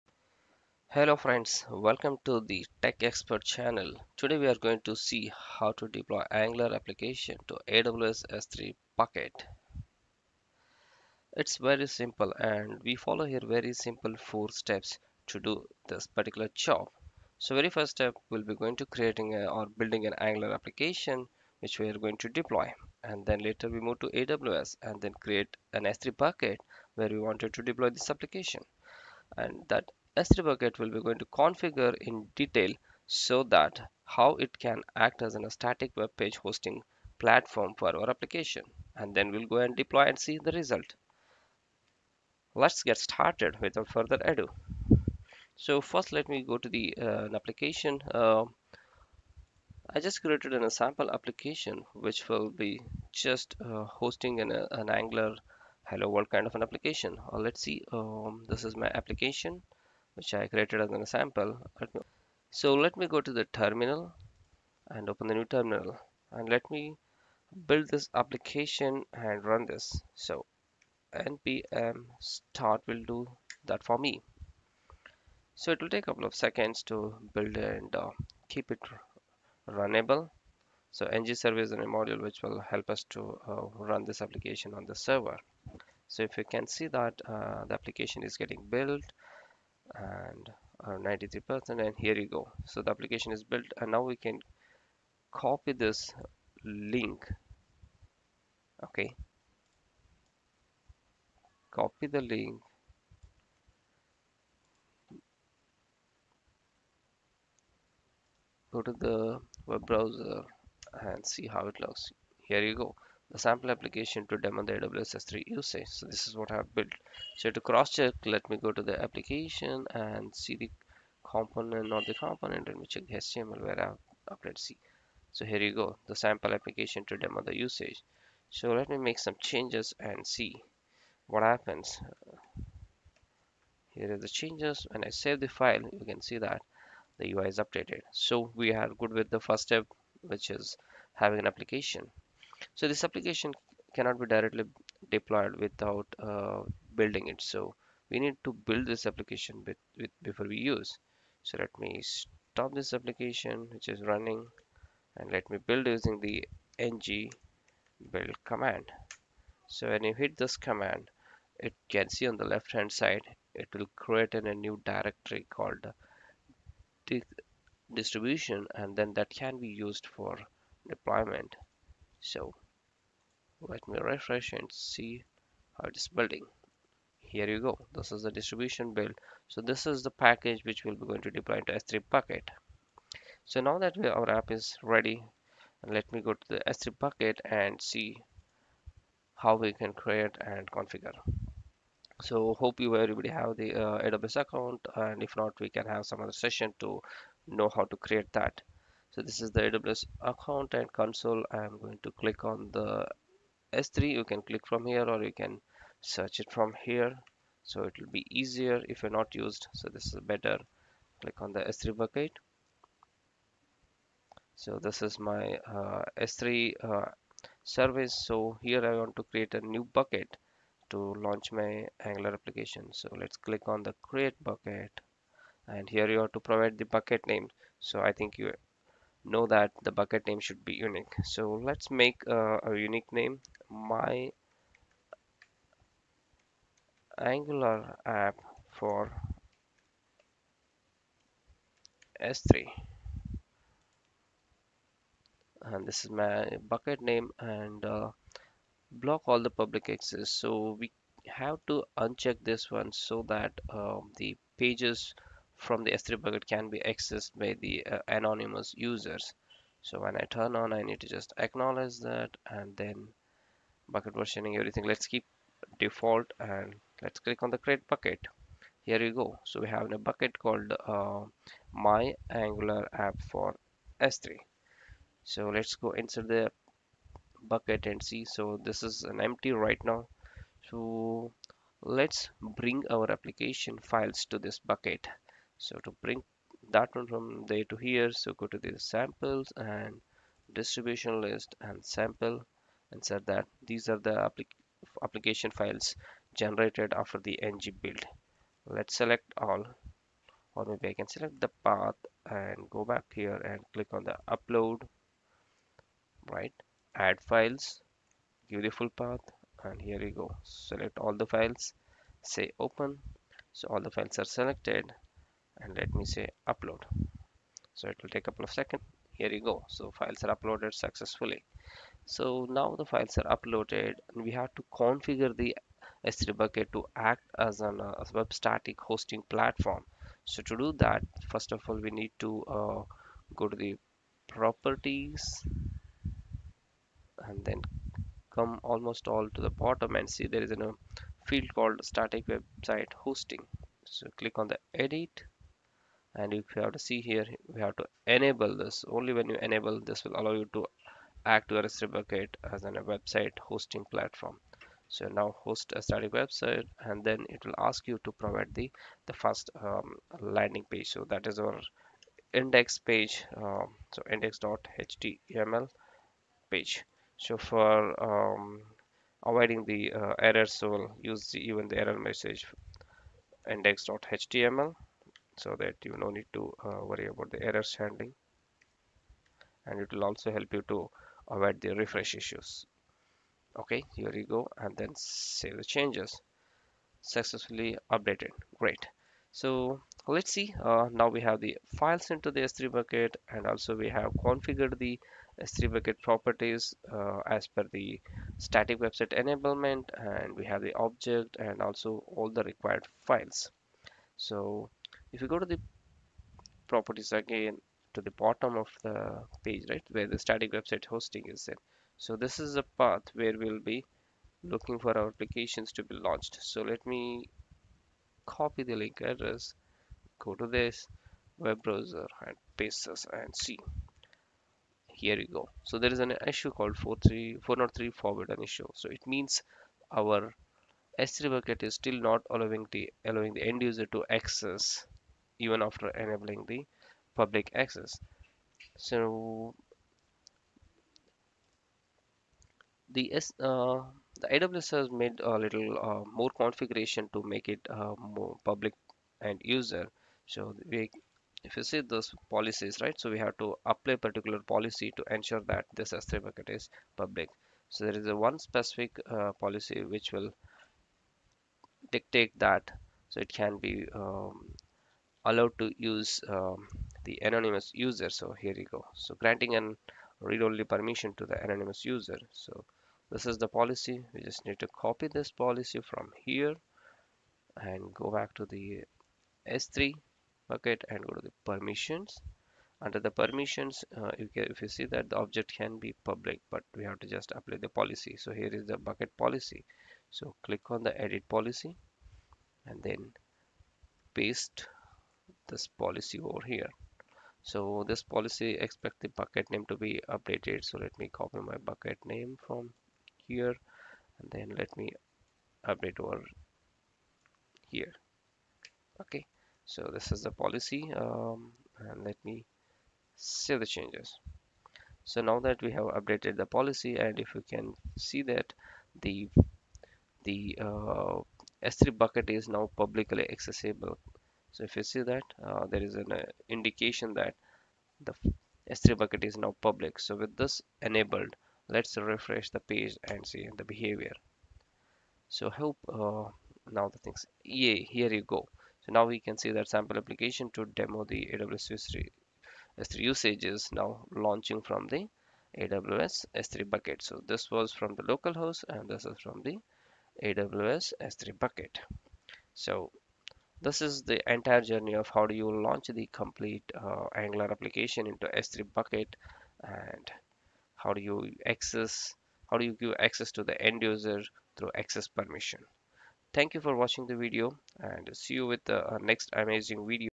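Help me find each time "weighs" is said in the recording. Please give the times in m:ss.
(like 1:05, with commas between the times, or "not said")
not said.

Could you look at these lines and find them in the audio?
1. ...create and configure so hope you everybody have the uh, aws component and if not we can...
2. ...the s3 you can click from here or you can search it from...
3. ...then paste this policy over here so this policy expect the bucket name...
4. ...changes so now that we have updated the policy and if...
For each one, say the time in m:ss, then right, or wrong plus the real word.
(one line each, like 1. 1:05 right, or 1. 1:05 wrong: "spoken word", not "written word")
1. 3:09 wrong: "account", not "component"
2. 3:22 right
3. 8:12 right
4. 8:33 right.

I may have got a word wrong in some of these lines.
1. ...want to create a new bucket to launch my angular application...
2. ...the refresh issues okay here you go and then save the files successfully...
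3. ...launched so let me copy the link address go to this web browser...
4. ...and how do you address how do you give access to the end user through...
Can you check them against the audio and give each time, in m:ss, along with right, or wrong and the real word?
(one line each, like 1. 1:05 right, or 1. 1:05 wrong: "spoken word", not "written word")
1. 3:38 right
2. 6:21 wrong: "changes", not "files"
3. 6:55 right
4. 9:19 wrong: "access", not "address".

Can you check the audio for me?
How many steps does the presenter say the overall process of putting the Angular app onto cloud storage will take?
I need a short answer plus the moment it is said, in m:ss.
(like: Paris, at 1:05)
4, at 0:14.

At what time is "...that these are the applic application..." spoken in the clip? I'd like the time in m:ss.
4:53.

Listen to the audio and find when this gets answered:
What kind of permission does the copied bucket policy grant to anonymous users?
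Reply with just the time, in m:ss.
7:50.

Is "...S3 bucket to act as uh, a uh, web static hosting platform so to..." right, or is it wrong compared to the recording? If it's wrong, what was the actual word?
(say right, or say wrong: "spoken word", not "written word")
right.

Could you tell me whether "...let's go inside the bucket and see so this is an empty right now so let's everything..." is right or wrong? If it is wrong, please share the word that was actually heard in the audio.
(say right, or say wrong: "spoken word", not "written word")
wrong: "bring", not "everything".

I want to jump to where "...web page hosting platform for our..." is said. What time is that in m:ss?
0:35.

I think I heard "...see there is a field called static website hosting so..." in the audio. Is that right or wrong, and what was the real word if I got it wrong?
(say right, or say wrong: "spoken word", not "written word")
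right.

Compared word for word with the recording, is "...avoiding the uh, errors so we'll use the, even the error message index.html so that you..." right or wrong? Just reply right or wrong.
right.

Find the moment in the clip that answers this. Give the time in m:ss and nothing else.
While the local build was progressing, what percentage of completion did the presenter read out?
1:30.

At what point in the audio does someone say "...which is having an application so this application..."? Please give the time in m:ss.
2:20.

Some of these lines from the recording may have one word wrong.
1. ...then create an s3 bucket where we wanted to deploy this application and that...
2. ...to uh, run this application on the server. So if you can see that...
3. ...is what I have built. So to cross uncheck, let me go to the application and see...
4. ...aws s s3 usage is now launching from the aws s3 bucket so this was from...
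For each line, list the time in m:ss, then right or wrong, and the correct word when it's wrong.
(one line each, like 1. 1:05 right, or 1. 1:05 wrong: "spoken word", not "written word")
1. 0:24 right
2. 1:23 right
3. 1:56 wrong: "check", not "uncheck"
4. 9:01 right.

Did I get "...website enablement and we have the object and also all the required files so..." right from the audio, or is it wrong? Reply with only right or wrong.
right.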